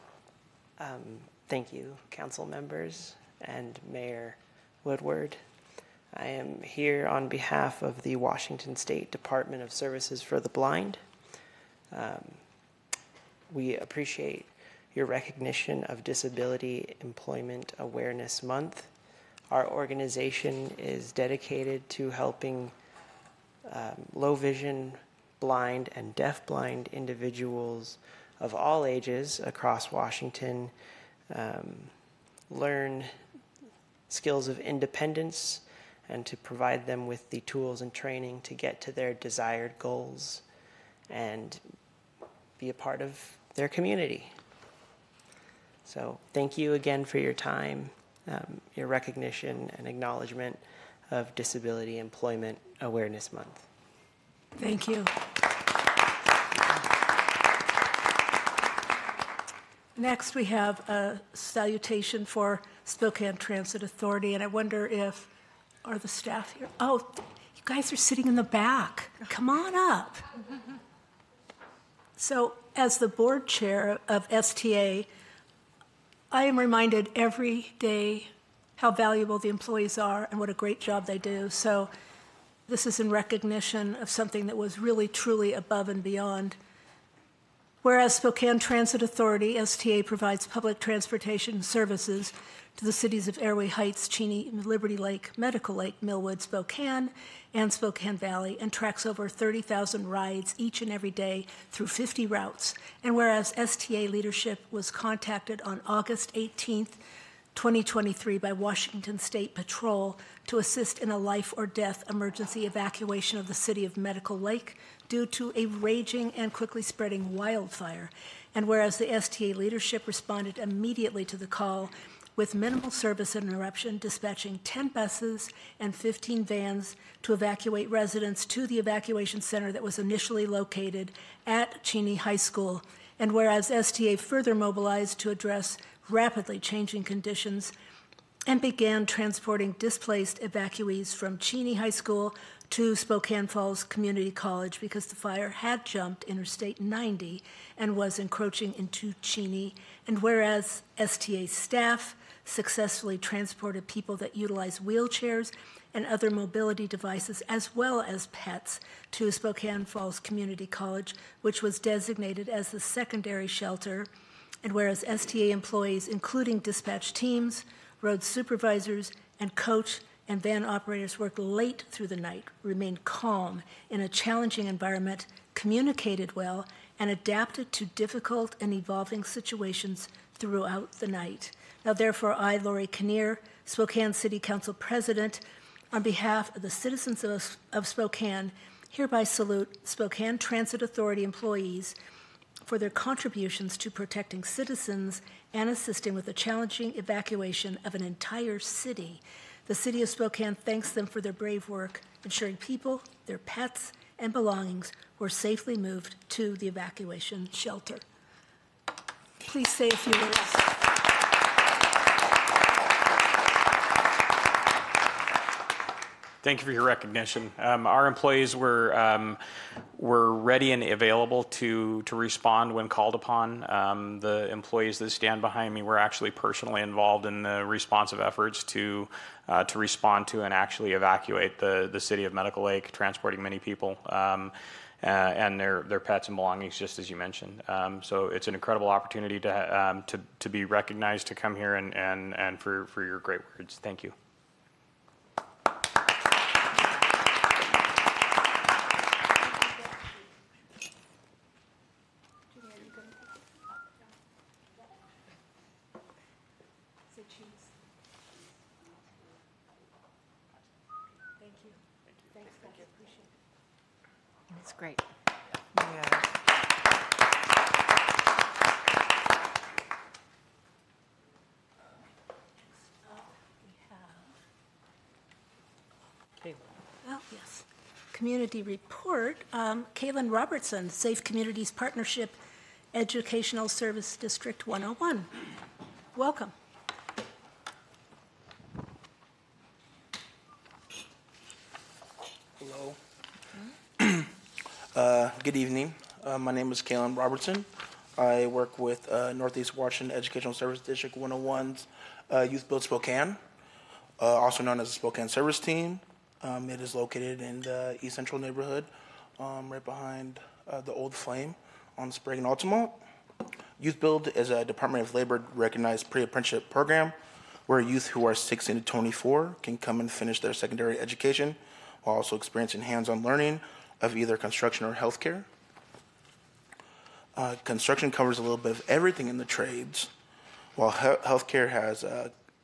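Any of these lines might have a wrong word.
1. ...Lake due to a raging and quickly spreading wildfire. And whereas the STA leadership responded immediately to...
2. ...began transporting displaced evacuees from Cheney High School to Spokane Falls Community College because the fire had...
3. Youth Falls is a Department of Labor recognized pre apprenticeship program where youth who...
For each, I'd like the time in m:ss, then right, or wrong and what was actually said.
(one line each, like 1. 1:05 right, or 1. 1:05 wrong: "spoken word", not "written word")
1. 1:54 right
2. 2:18 right
3. 5:13 wrong: "Build", not "Falls".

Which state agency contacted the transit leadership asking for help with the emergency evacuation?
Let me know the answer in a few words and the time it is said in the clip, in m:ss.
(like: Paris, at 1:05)
Washington State Patrol, at 1:48.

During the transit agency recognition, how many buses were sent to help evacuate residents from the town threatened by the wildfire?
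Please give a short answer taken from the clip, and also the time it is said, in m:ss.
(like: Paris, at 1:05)
10, at 2:04.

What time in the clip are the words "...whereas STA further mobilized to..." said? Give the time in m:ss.
2:13.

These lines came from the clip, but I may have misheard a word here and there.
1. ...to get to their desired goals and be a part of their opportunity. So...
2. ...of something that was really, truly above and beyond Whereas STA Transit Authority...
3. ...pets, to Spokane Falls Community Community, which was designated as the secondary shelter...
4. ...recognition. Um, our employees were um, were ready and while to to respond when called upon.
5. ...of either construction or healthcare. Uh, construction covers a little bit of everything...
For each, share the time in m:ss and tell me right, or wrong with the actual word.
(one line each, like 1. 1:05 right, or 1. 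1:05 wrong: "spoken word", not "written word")
1. 0:38 wrong: "community", not "opportunity"
2. 1:23 wrong: "Spokane", not "STA"
3. 2:38 wrong: "College", not "Community"
4. 3:36 wrong: "available", not "while"
5. 5:24 right.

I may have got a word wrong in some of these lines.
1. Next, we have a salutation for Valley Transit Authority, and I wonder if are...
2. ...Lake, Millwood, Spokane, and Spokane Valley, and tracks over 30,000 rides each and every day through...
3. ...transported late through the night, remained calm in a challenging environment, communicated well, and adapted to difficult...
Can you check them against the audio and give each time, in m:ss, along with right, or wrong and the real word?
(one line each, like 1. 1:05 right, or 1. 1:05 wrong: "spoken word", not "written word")
1. 0:59 wrong: "Spokane", not "Valley"
2. 1:35 right
3. 2:51 wrong: "worked", not "transported".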